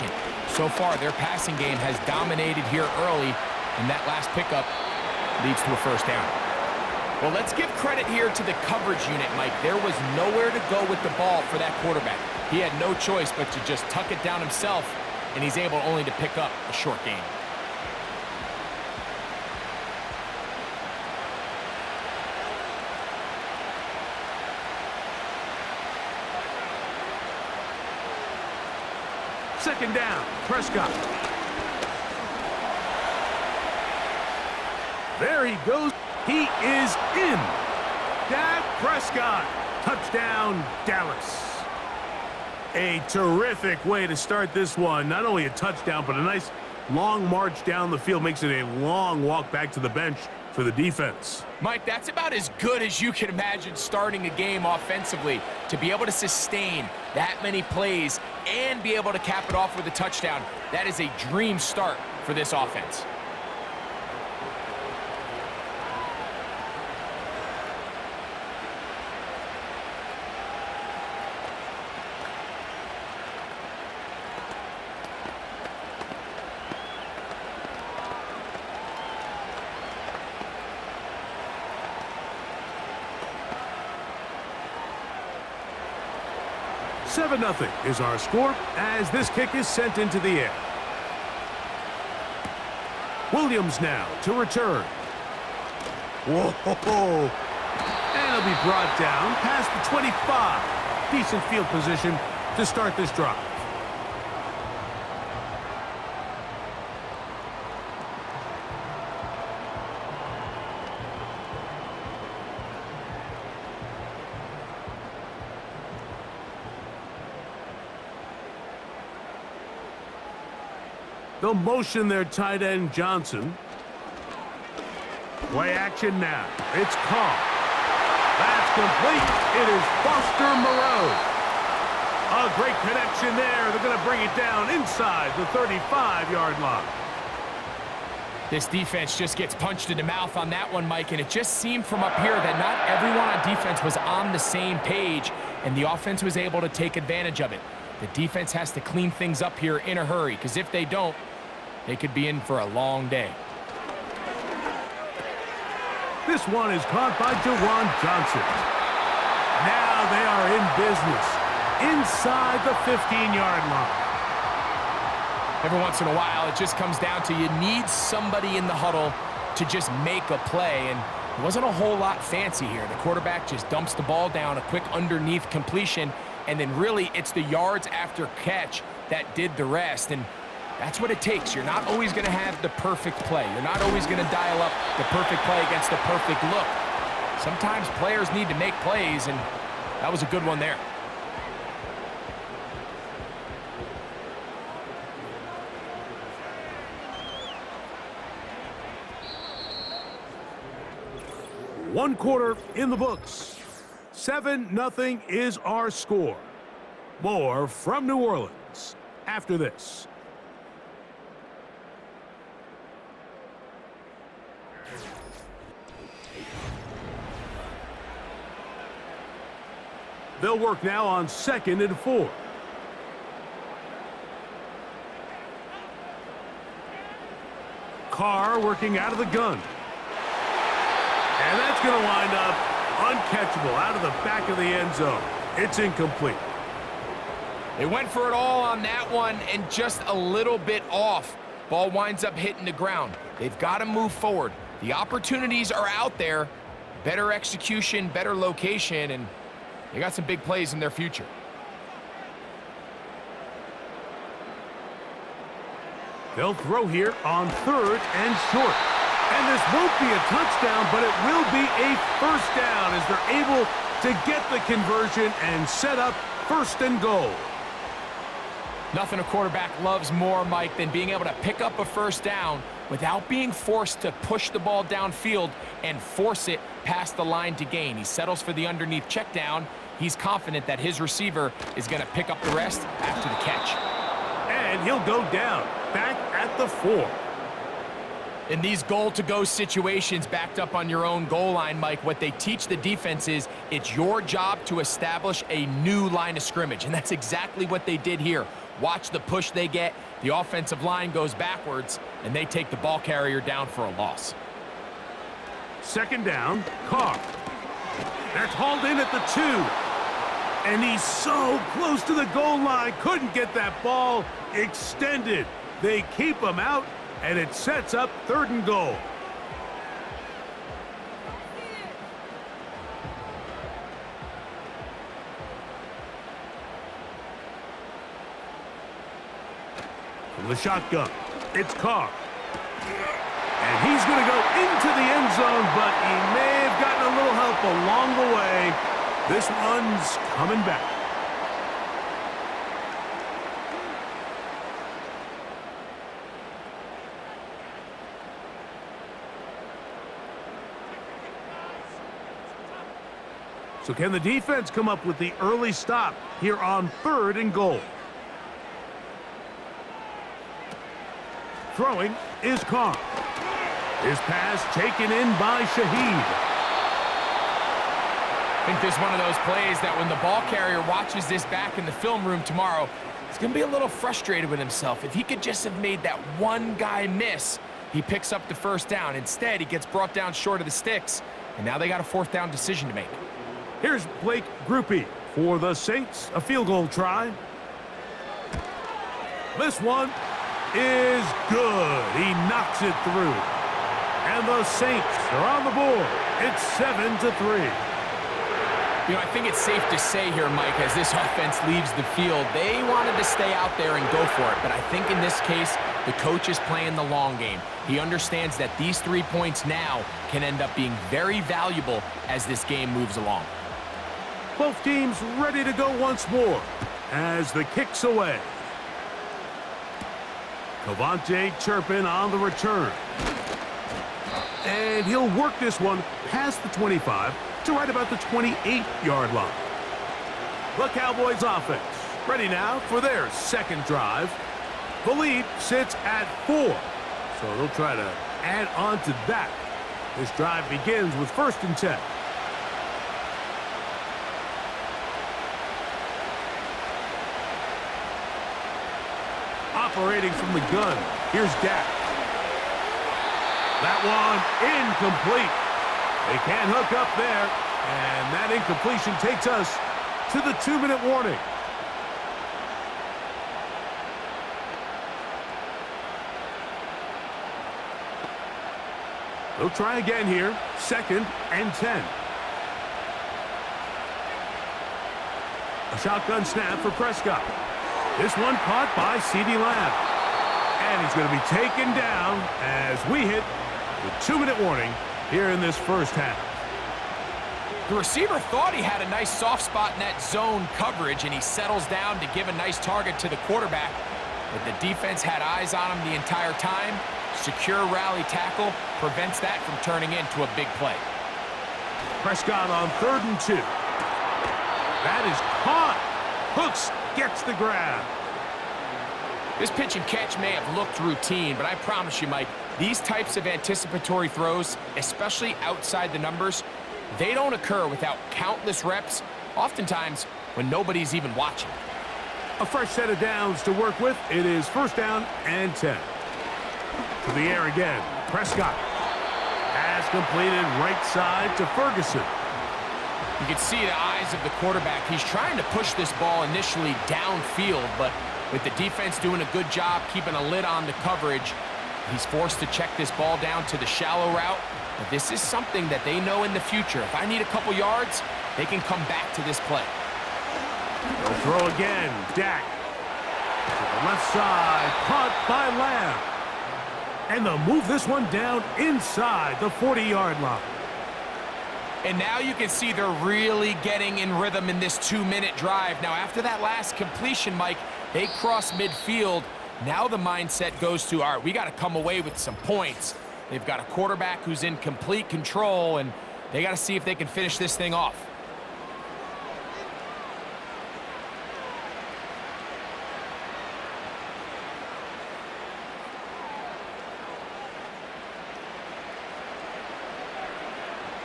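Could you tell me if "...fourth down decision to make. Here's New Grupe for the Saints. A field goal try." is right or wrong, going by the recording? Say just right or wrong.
wrong.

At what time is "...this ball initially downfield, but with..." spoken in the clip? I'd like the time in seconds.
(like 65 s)
535 s.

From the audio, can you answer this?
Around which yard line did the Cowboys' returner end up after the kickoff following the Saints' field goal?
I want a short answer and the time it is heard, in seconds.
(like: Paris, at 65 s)
28, at 428 s.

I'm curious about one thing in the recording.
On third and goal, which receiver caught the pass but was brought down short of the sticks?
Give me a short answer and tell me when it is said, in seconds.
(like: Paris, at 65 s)
Shaheed, at 365 s.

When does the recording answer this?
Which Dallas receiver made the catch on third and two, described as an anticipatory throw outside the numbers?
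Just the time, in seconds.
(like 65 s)
506 s.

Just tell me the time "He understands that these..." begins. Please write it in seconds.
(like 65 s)
407 s.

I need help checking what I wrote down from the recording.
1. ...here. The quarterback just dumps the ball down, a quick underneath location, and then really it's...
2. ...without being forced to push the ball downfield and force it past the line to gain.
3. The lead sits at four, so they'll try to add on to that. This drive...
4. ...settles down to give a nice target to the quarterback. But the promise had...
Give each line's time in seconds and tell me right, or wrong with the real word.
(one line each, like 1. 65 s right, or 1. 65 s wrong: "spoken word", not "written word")
1. 172 s wrong: "completion", not "location"
2. 272 s right
3. 435 s right
4. 491 s wrong: "defense", not "promise".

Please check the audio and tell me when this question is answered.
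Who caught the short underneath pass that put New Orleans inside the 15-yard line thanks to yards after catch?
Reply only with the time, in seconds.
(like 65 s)
157 s.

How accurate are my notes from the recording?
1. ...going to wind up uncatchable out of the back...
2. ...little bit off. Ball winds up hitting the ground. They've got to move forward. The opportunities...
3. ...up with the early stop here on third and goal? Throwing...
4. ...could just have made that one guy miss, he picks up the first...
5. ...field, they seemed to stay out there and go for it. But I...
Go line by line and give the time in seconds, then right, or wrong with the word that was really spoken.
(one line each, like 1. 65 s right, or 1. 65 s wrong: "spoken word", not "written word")
1. 231 s right
2. 240 s right
3. 354 s right
4. 375 s right
5. 402 s wrong: "wanted", not "seemed".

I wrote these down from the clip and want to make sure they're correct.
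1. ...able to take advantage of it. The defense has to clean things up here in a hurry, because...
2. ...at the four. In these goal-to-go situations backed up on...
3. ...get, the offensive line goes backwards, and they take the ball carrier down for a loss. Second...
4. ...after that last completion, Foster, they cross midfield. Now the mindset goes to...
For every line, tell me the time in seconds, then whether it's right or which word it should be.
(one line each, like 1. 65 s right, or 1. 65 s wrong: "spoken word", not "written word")
1. 146 s right
2. 286 s right
3. 299 s right
4. 566 s wrong: "Mike", not "Foster".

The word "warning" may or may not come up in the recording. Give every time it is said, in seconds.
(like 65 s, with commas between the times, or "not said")
461 s, 484 s.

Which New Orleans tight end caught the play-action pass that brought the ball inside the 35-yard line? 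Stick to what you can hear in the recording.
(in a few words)
Foster Moreau.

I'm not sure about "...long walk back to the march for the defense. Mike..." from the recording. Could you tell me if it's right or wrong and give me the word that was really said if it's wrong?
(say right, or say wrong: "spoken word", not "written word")
wrong: "bench", not "march".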